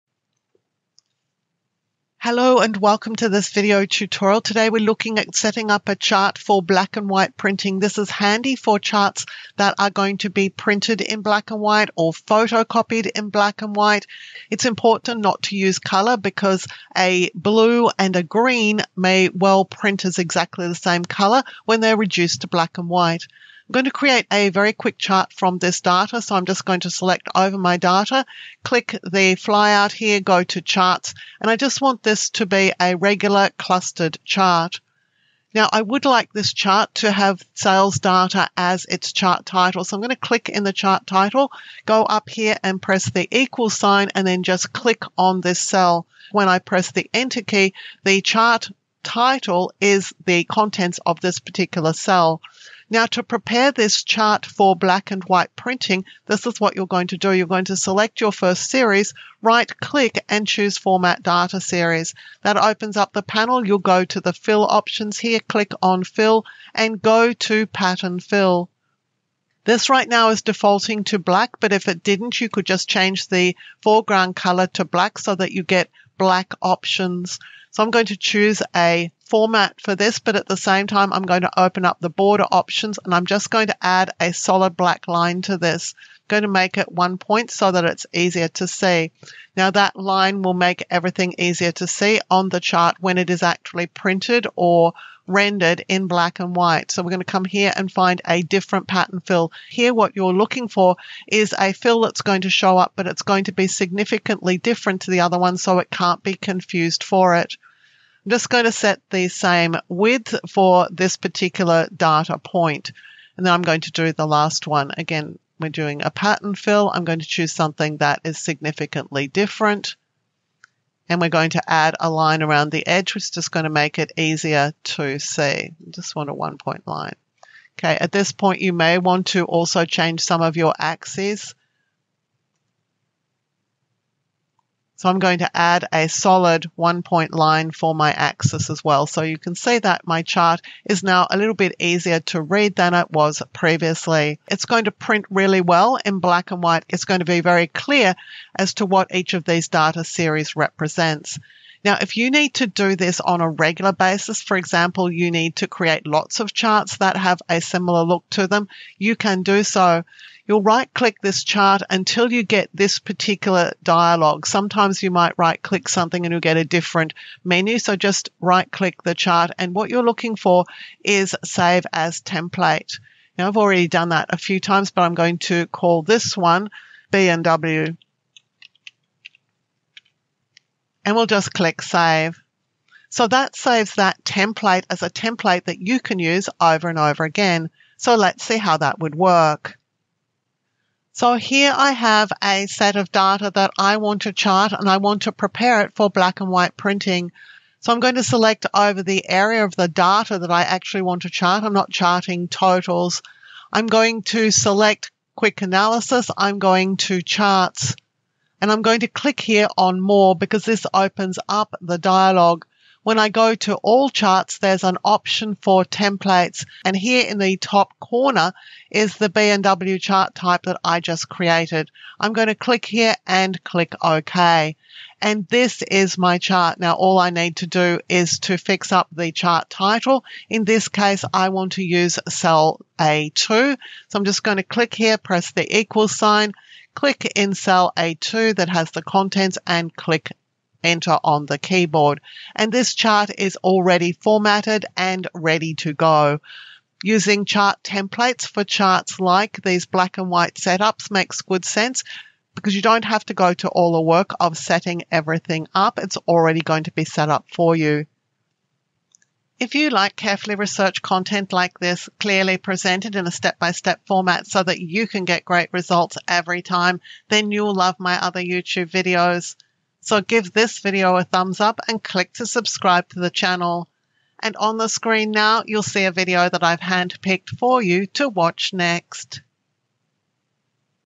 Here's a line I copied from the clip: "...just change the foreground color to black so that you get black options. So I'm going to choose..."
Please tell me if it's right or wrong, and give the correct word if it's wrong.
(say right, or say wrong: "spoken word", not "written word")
right.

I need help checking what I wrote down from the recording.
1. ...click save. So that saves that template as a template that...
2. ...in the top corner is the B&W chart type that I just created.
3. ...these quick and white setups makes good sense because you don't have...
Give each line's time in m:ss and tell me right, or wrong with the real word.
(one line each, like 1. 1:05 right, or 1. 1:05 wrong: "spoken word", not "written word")
1. 3:01 right
2. 3:37 right
3. 4:09 wrong: "black", not "quick".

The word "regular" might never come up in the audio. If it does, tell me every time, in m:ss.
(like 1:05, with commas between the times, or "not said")
0:32, 2:33.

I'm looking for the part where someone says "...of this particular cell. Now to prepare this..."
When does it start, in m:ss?
0:51.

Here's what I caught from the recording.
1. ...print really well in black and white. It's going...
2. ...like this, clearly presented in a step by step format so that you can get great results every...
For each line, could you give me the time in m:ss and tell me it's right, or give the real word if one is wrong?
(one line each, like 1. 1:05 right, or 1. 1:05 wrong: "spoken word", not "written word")
1. 2:24 right
2. 4:21 right.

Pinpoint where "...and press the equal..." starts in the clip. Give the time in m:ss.
0:42.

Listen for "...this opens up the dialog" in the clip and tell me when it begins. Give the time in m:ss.
3:30.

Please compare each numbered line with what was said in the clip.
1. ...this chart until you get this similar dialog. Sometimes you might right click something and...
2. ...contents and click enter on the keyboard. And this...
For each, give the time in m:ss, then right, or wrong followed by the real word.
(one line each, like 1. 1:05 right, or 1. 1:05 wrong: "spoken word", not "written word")
1. 2:41 wrong: "particular", not "similar"
2. 3:59 right.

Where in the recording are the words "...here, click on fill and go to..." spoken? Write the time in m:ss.
1:05.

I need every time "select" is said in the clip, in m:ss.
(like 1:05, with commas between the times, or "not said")
0:26, 0:57, 3:18, 3:24.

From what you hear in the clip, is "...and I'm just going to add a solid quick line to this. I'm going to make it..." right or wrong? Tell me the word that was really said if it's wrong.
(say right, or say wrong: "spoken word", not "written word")
wrong: "black", not "quick".